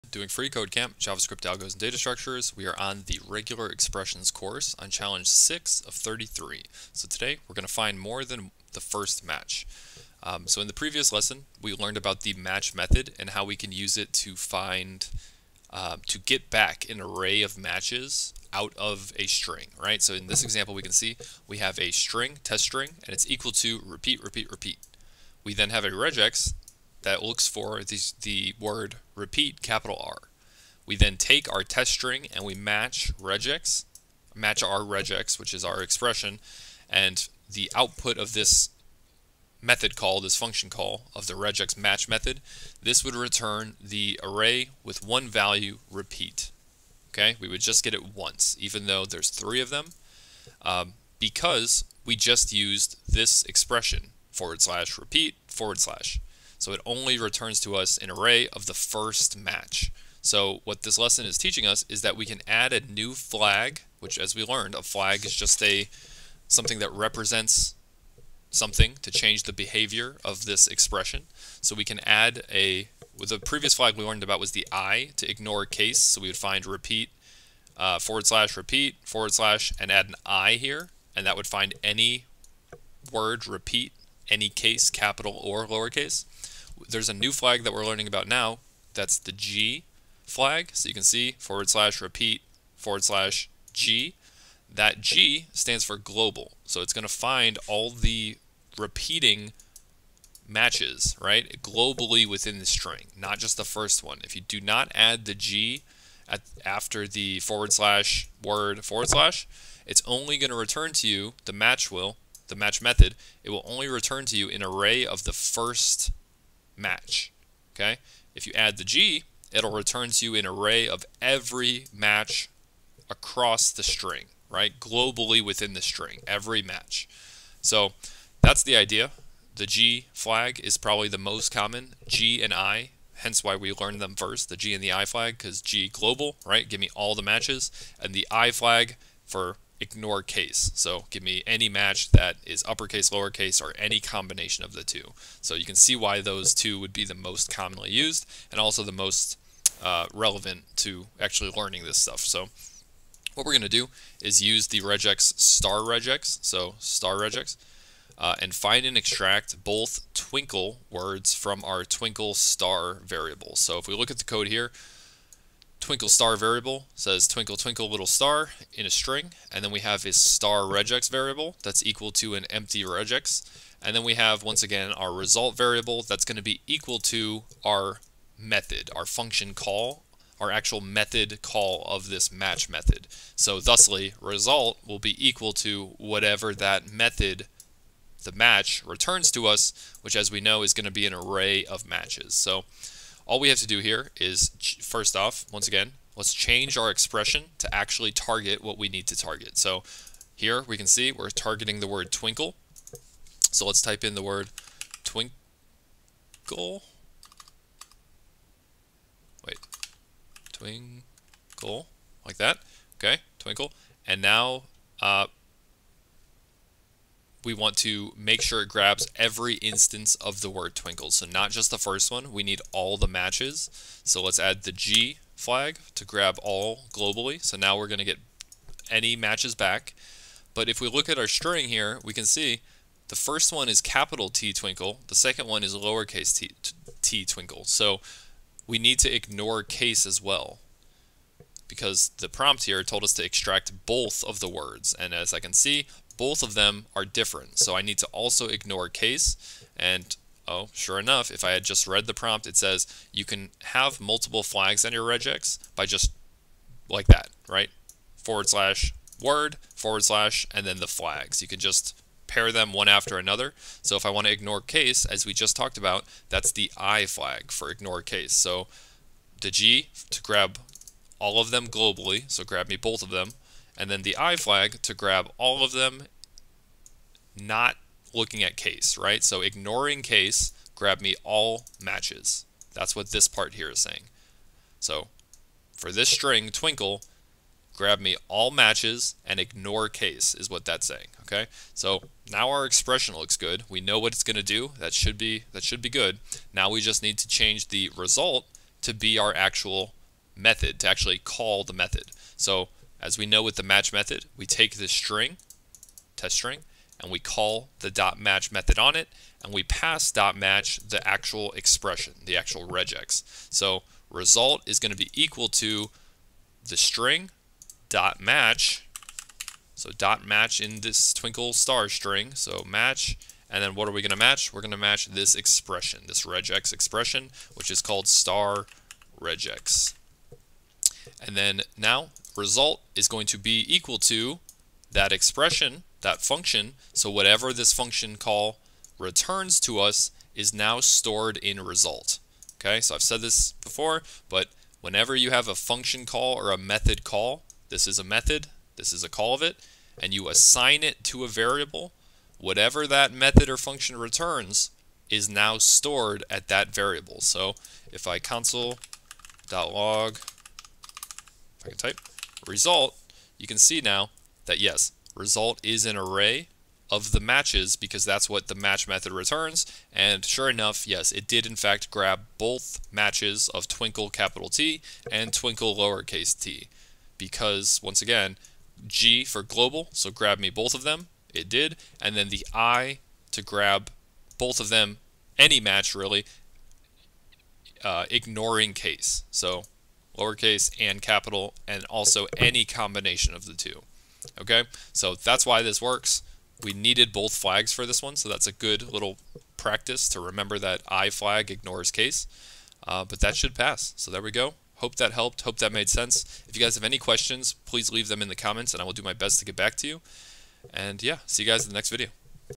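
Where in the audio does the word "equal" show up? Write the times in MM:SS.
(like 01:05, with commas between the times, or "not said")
00:23, 02:51, 02:56, 03:05, 05:15, 05:33.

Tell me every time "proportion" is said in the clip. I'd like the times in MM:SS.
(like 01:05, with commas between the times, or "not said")
not said.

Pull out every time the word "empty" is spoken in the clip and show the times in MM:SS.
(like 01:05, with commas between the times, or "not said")
02:52.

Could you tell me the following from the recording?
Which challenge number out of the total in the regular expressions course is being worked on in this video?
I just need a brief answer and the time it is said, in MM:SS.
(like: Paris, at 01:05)
6, at 00:04.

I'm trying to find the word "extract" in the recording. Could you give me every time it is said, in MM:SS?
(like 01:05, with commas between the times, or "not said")
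02:38, 04:03.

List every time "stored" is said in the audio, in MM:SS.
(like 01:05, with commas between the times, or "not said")
05:40, 05:55.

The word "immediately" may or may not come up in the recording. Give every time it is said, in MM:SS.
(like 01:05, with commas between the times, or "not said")
not said.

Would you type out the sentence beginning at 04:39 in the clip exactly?
So ignoring case, grab me all matches.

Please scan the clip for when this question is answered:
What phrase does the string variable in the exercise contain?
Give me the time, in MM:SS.
02:47.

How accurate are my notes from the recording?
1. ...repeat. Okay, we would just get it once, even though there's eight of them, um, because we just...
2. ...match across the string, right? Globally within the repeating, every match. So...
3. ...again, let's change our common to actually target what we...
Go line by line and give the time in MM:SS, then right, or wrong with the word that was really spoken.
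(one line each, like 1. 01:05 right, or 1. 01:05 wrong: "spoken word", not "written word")
1. 00:45 wrong: "three", not "eight"
2. 02:01 wrong: "string", not "repeating"
3. 03:15 wrong: "expression", not "common".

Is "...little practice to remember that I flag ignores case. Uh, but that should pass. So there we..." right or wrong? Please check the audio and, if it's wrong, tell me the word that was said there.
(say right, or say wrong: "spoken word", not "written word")
right.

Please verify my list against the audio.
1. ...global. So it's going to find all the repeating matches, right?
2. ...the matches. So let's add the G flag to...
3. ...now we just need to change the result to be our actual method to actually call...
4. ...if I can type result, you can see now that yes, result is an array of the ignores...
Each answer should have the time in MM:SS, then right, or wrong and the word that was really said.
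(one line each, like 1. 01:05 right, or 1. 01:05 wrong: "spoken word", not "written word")
1. 01:35 right
2. 03:42 right
3. 04:56 right
4. 06:01 wrong: "matches", not "ignores".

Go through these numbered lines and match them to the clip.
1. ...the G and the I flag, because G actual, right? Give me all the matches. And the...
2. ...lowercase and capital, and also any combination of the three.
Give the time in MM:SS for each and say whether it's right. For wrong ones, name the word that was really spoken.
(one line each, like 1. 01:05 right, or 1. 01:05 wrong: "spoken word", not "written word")
1. 02:14 wrong: "global", not "actual"
2. 06:30 wrong: "two", not "three".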